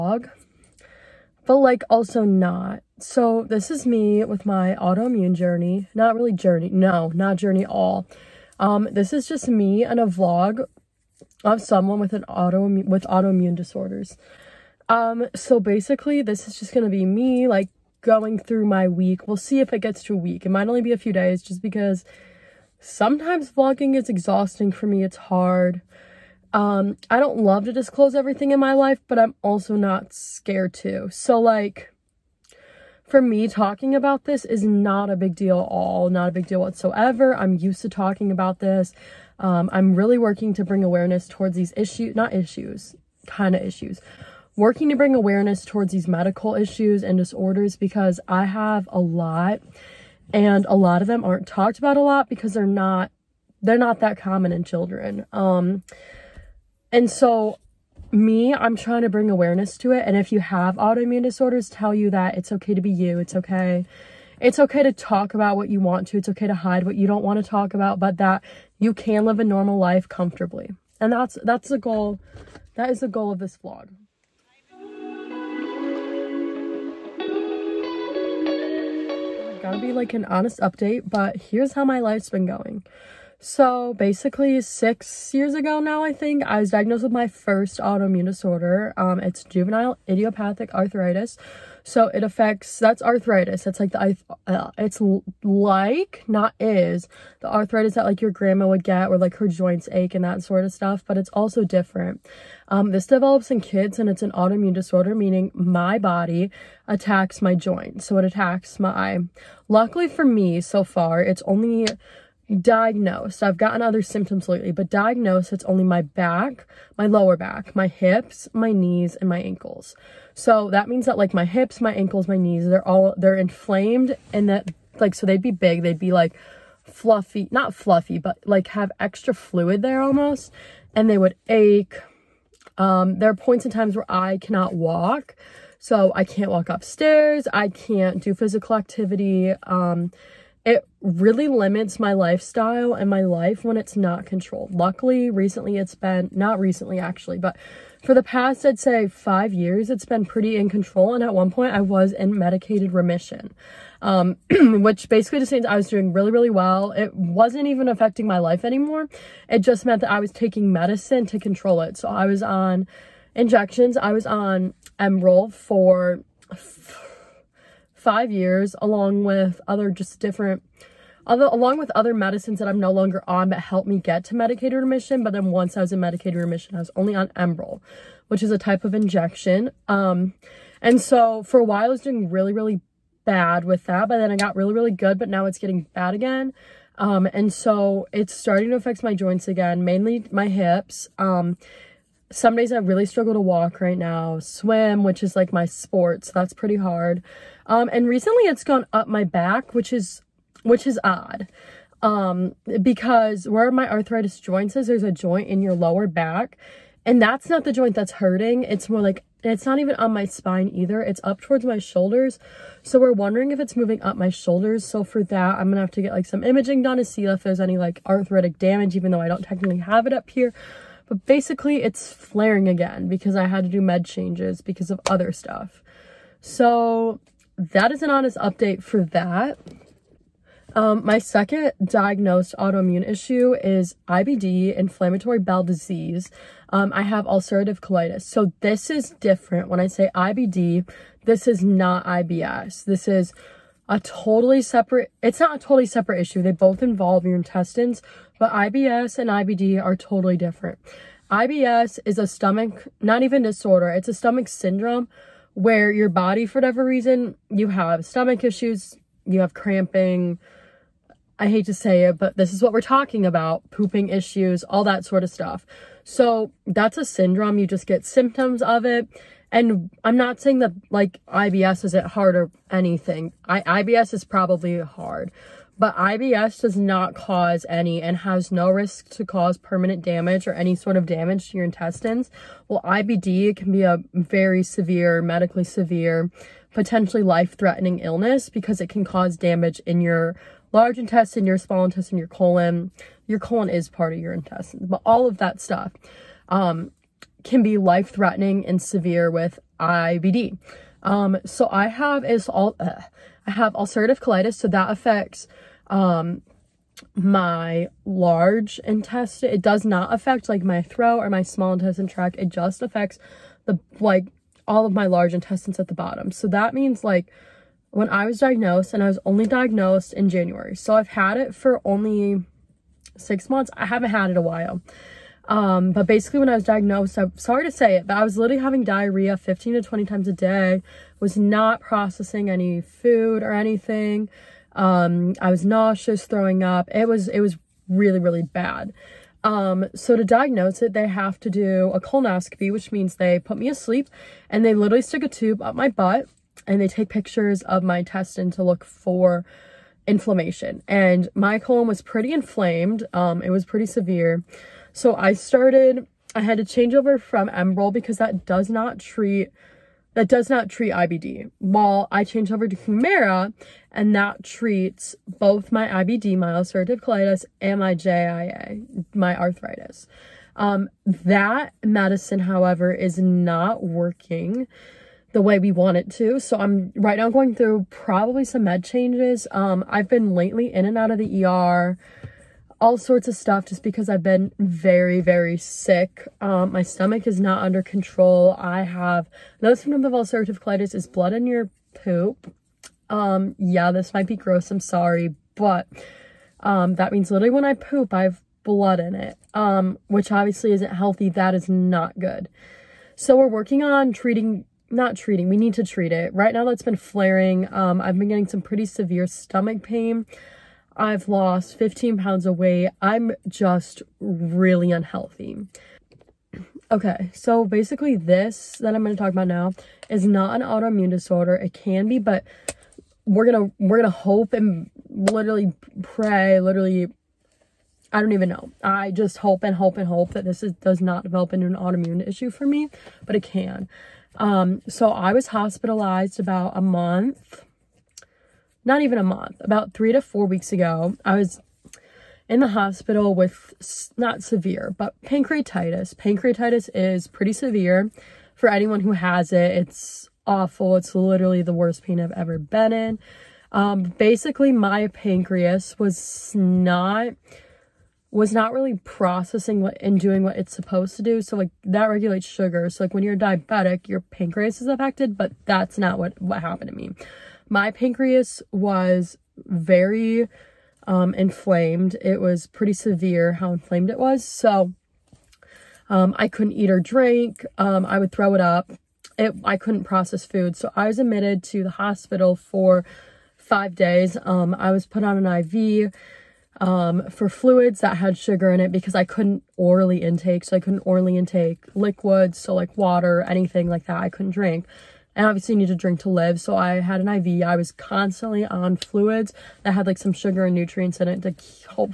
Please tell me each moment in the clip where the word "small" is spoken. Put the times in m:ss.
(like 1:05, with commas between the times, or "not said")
4:51, 5:11.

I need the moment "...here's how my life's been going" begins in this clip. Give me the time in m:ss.
1:21.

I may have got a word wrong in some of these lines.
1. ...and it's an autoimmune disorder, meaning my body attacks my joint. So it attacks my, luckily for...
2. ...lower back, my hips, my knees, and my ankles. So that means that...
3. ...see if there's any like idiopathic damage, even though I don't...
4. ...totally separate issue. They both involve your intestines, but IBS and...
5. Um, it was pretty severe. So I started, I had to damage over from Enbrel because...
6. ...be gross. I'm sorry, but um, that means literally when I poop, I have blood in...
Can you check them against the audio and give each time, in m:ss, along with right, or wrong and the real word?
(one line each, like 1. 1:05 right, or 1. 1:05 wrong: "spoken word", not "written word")
1. 1:43 right
2. 1:57 right
3. 3:37 wrong: "arthritic", not "idiopathic"
4. 4:05 right
5. 5:53 wrong: "change", not "damage"
6. 6:34 right.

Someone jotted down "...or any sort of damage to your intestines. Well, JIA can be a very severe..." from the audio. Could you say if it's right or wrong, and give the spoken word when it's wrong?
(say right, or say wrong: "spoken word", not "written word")
wrong: "IBD", not "JIA".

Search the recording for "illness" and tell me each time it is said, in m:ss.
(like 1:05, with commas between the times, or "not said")
4:47.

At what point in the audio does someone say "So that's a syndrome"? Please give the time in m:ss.
4:26.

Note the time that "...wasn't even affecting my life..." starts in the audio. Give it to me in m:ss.
2:37.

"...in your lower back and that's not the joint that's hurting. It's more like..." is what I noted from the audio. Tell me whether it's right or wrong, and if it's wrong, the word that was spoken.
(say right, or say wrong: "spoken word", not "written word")
right.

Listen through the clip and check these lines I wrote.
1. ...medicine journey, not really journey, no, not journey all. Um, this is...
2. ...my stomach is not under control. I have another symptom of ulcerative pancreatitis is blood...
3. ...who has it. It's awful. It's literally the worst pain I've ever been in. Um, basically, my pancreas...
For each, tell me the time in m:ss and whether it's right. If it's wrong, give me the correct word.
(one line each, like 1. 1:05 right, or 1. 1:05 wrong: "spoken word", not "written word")
1. 0:04 wrong: "autoimmune", not "medicine"
2. 6:26 wrong: "colitis", not "pancreatitis"
3. 7:29 right.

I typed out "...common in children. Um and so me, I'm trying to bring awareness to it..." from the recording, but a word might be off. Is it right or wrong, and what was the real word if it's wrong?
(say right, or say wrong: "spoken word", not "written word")
right.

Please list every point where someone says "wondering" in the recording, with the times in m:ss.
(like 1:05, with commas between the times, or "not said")
3:33.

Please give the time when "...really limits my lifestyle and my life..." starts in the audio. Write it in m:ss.
2:21.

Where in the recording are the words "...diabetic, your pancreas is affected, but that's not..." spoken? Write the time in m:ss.
7:43.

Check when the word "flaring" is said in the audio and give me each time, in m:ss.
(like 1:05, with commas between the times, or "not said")
3:42, 6:46.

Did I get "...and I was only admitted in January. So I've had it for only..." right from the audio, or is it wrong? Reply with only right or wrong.
wrong.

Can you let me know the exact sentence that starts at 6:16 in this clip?
So I'm right now going through probably some med changes.